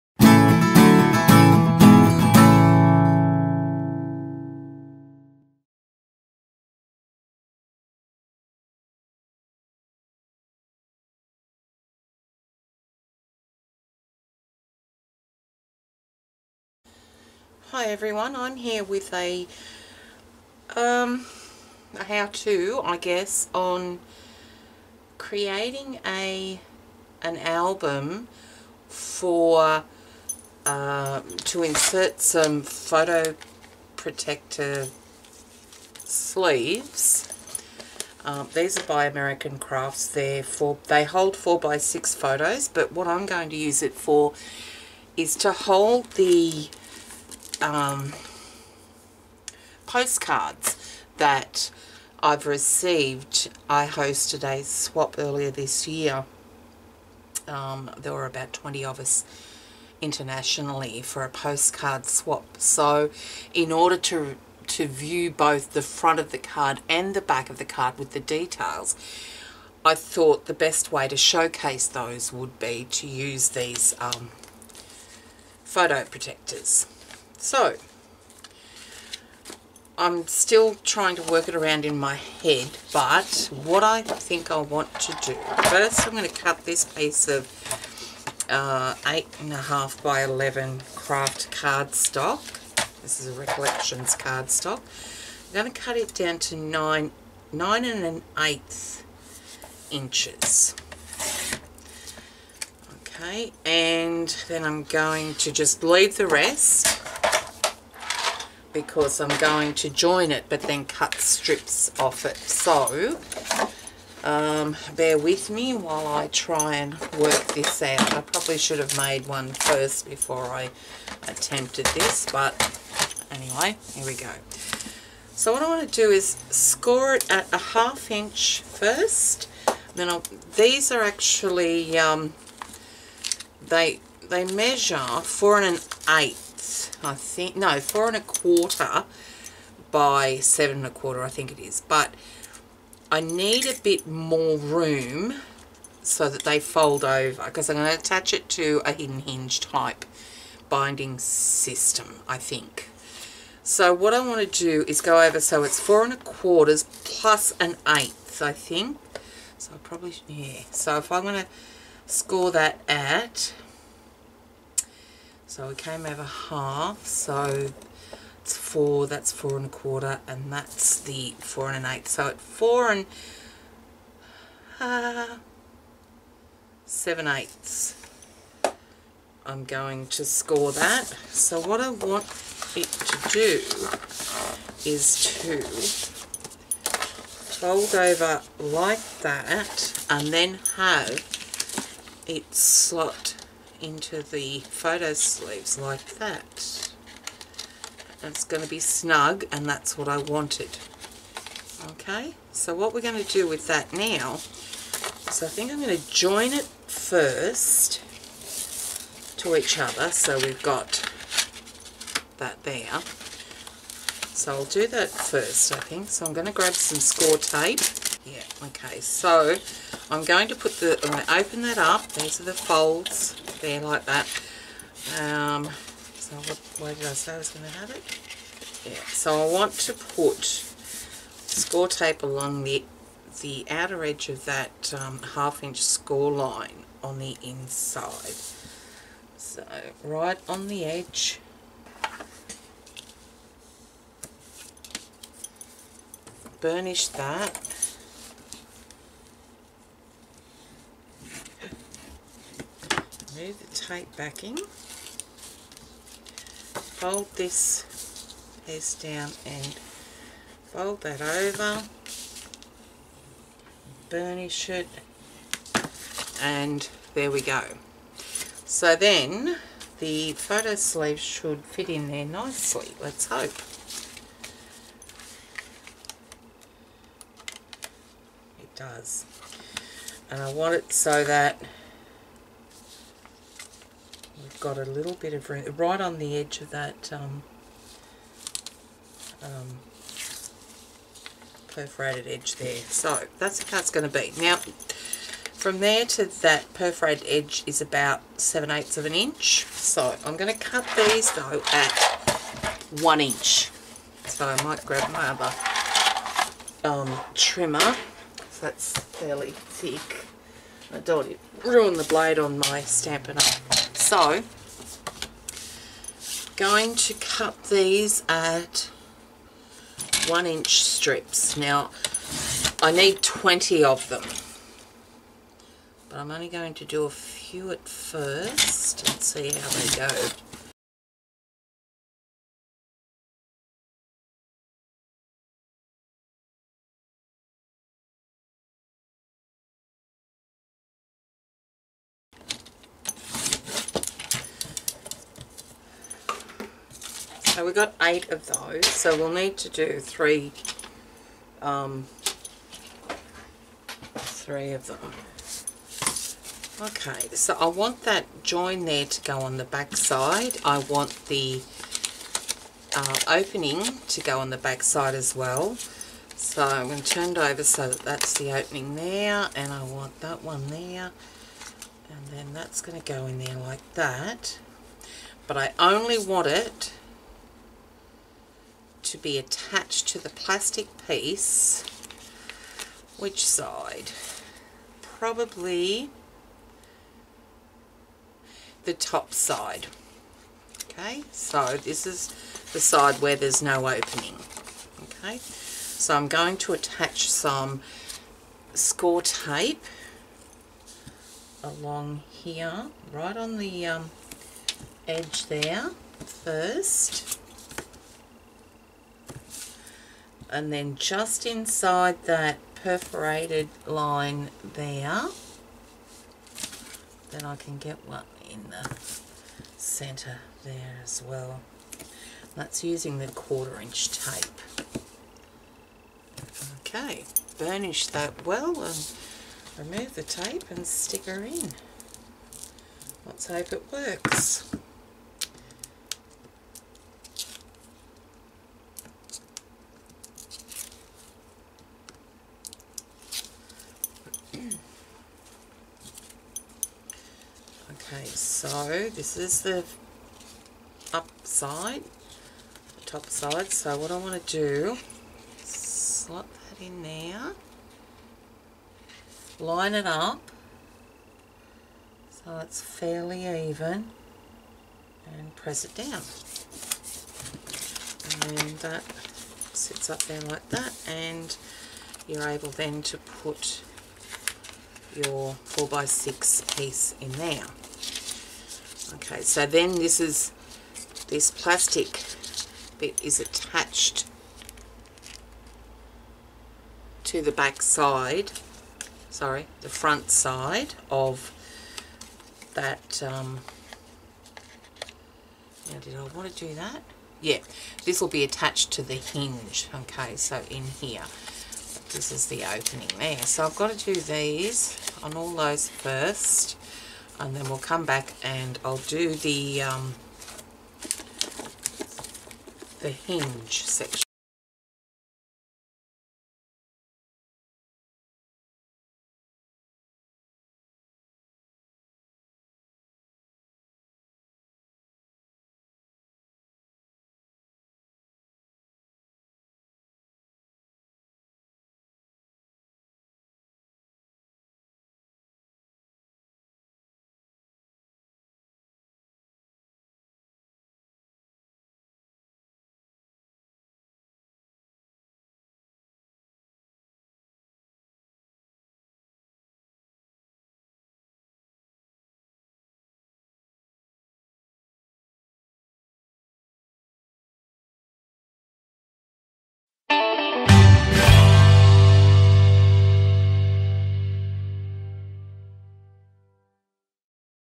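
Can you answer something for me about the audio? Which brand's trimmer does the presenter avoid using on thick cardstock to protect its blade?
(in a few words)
Stampin' Up.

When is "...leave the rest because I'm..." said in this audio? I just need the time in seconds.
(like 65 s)
105 s.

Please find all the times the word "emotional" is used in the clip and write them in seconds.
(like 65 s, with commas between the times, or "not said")
not said.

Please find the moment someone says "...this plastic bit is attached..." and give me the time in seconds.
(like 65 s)
481 s.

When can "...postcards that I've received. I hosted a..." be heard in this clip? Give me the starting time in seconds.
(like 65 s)
49 s.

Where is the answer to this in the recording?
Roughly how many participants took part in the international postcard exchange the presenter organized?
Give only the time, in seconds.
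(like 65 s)
58 s.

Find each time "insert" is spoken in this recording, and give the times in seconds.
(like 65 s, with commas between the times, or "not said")
31 s.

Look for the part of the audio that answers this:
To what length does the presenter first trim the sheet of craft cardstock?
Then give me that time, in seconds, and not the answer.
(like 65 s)
97 s.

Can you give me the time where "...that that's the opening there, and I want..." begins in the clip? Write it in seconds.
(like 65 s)
367 s.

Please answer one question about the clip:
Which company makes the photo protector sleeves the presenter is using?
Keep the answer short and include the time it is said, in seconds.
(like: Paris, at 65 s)
American Crafts, at 39 s.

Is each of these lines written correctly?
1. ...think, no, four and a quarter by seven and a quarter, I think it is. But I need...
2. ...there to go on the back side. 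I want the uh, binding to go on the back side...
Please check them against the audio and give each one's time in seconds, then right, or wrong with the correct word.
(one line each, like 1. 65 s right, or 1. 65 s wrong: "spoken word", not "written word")
1. 137 s right
2. 358 s wrong: "opening", not "binding".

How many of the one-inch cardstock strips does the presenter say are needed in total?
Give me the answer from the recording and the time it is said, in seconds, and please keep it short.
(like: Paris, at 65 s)
20, at 322 s.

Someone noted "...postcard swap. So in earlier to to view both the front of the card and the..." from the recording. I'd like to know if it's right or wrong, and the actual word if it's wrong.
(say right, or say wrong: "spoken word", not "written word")
wrong: "order", not "earlier".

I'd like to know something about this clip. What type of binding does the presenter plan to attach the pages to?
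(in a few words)
hidden hinge.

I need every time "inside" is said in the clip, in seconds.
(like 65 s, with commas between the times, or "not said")
237 s, 411 s.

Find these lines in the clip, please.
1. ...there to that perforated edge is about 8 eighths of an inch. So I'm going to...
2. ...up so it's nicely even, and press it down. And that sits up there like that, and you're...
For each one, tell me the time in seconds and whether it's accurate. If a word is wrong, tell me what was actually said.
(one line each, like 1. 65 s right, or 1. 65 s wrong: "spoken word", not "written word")
1. 295 s wrong: "7", not "8"
2. 460 s wrong: "fairly", not "nicely".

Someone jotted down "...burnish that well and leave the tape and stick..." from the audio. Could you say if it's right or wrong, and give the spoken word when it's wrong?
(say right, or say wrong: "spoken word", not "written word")
wrong: "remove", not "leave".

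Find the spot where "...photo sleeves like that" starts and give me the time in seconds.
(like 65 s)
194 s.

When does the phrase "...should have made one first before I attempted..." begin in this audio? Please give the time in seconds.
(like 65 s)
118 s.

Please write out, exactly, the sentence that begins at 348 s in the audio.
So we'll need to do three, um, three of them.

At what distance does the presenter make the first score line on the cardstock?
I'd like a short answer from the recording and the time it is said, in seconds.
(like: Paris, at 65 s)
1/2 inch, at 127 s.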